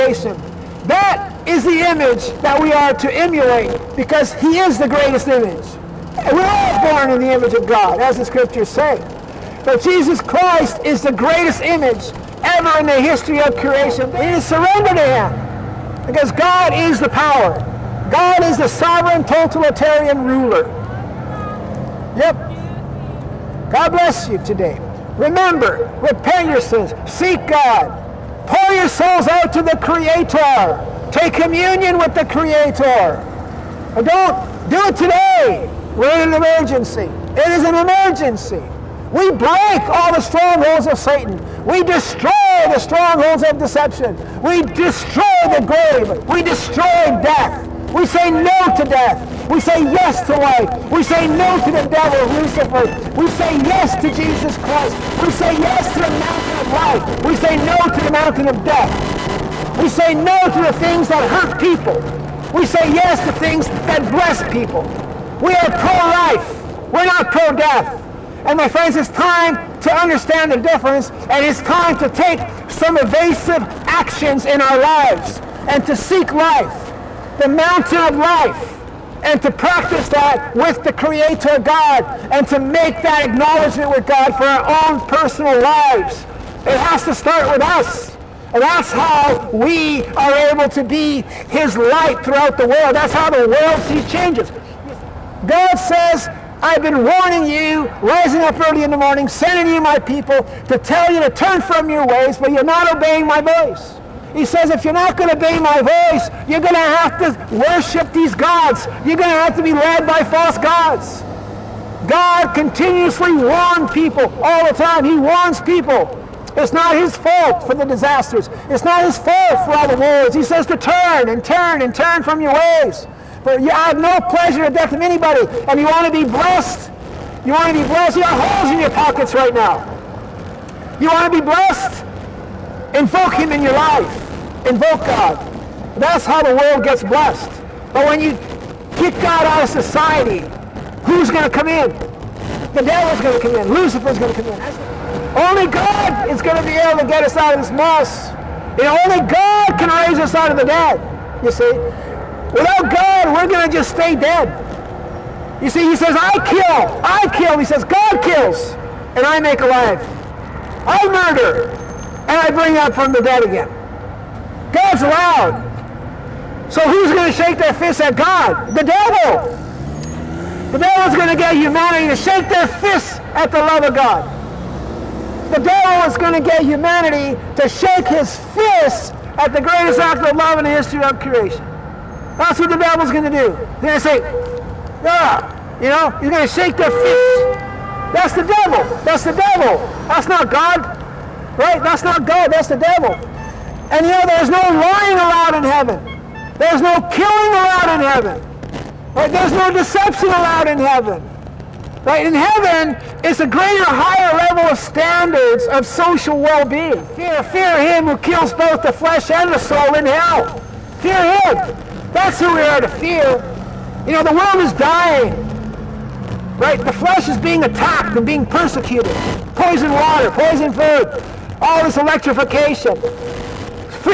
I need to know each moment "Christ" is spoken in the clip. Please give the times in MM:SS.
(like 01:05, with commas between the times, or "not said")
00:10, 00:54.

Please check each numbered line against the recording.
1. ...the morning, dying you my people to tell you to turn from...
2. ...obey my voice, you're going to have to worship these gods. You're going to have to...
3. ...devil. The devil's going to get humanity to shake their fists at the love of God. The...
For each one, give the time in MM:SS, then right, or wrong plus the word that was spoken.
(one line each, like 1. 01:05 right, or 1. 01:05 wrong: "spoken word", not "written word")
1. 01:38 wrong: "sending", not "dying"
2. 01:45 right
3. 02:48 right.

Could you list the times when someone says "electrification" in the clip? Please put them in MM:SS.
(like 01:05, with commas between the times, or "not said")
03:41.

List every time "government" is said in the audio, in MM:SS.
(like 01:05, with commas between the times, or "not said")
not said.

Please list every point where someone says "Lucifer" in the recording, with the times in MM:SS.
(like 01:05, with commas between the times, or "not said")
00:52, 02:23.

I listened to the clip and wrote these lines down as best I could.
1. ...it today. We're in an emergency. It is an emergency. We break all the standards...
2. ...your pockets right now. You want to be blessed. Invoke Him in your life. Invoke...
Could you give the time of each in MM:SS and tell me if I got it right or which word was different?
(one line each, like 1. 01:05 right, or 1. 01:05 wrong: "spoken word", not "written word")
1. 00:34 wrong: "strongholds", not "standards"
2. 02:08 right.